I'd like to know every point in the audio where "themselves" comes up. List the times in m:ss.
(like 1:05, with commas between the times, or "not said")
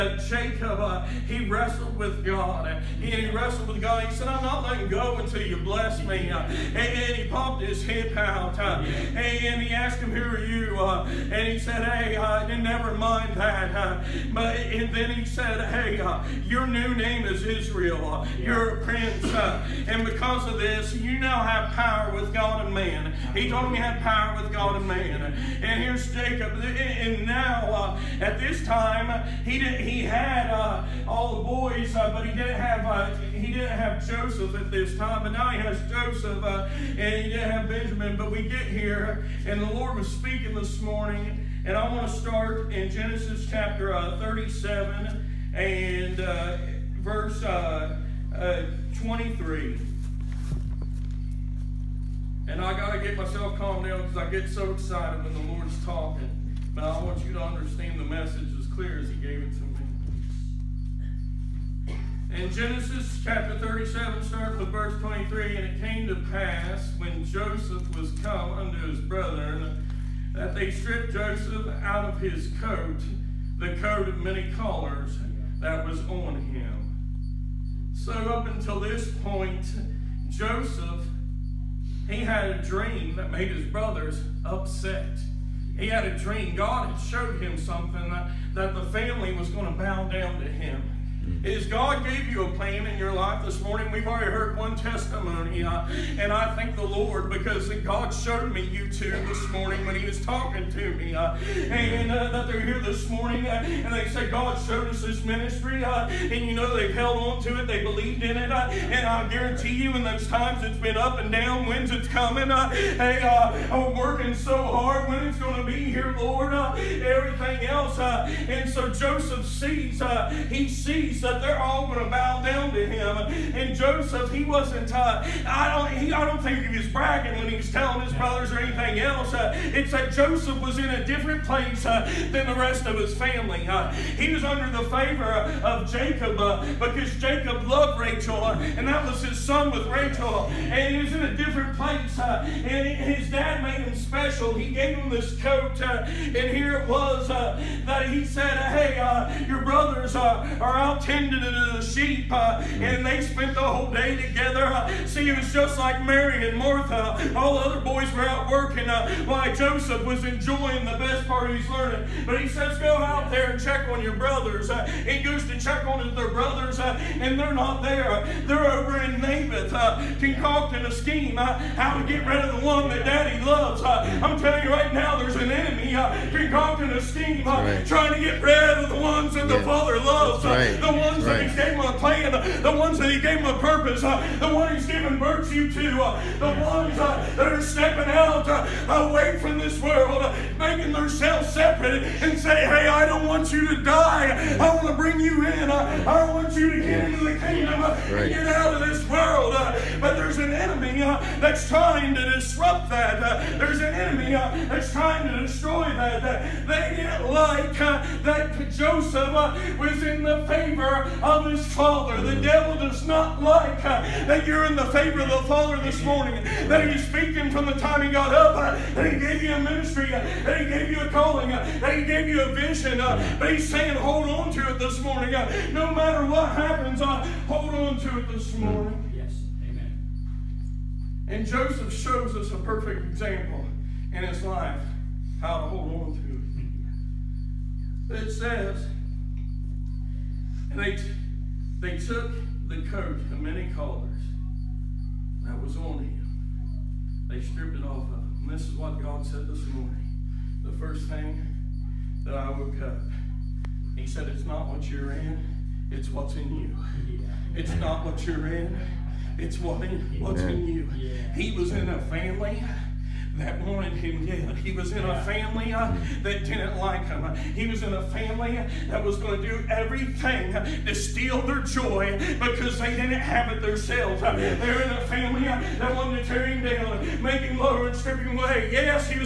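3:10, 4:33.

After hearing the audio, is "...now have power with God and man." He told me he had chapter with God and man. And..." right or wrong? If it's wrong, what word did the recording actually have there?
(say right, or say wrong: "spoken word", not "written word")
wrong: "power", not "chapter".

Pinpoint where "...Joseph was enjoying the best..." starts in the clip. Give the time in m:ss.
2:39.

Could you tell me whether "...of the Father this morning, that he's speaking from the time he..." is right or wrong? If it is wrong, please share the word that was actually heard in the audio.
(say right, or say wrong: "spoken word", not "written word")
right.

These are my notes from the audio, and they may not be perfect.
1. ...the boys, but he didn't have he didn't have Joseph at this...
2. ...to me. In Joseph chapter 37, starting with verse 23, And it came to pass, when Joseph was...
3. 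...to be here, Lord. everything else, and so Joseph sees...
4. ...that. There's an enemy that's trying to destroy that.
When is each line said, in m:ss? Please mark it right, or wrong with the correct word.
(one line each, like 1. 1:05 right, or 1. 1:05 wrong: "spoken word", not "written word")
1. 0:31 right
2. 0:59 wrong: "Genesis", not "Joseph"
3. 1:55 right
4. 3:22 right.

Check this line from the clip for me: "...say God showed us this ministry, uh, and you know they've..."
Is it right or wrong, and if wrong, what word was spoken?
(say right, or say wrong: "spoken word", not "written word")
right.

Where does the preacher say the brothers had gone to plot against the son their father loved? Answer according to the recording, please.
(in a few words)
Naboth.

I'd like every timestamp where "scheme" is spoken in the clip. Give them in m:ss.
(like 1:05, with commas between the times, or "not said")
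2:50, 2:57.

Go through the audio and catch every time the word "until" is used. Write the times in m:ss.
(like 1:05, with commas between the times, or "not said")
0:05, 1:18.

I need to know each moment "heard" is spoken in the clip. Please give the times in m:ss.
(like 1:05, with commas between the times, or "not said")
1:34.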